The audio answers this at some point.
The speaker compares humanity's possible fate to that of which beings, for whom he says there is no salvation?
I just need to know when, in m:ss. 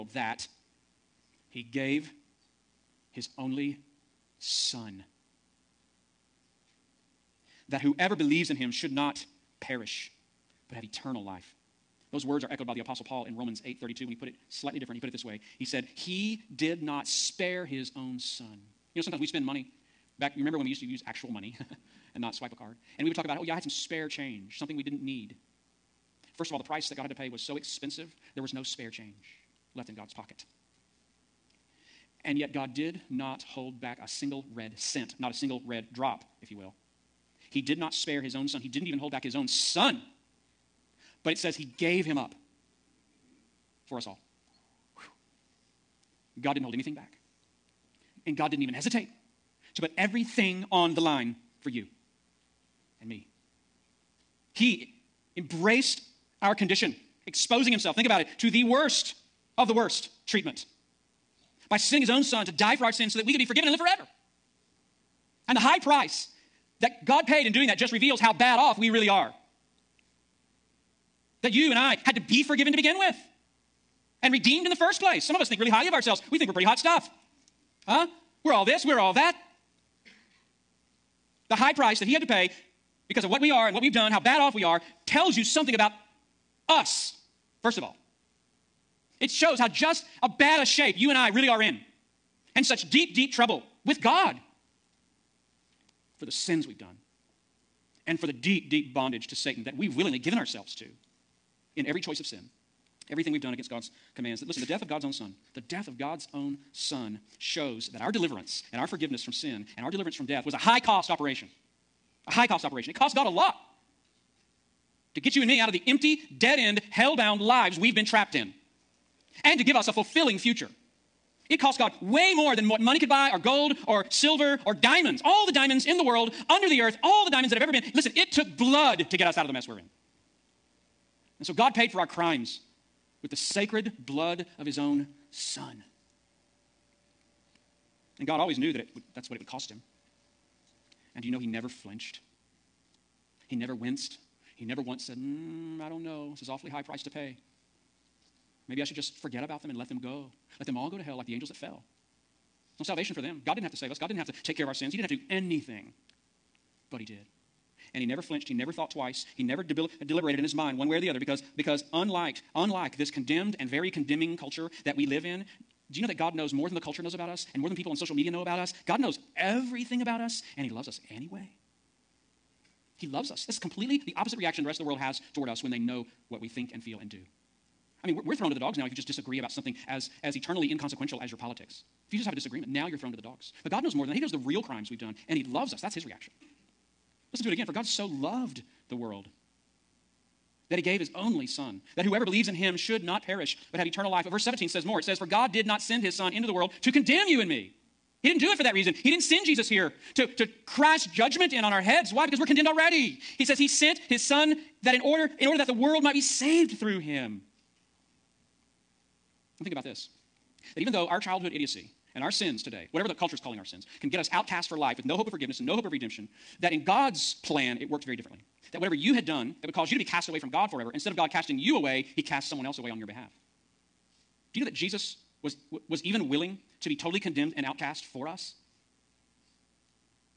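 2:31.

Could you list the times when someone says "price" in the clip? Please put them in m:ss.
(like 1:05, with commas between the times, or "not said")
0:26, 1:05, 1:21, 2:26.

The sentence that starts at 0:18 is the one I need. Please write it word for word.
You know, sometimes we spend money.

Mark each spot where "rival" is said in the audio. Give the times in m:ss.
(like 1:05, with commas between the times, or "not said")
not said.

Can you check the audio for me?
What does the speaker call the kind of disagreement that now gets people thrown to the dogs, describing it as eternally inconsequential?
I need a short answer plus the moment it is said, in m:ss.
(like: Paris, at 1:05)
politics, at 3:01.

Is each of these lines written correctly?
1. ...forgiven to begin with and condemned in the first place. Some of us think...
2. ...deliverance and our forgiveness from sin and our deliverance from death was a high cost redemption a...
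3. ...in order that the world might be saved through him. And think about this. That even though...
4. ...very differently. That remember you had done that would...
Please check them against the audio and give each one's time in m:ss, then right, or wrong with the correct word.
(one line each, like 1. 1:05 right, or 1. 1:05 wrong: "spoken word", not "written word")
1. 1:12 wrong: "redeemed", not "condemned"
2. 1:48 wrong: "operation", not "redemption"
3. 3:25 right
4. 3:38 wrong: "whatever", not "remember".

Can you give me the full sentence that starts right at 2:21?
And do you know he never flinched?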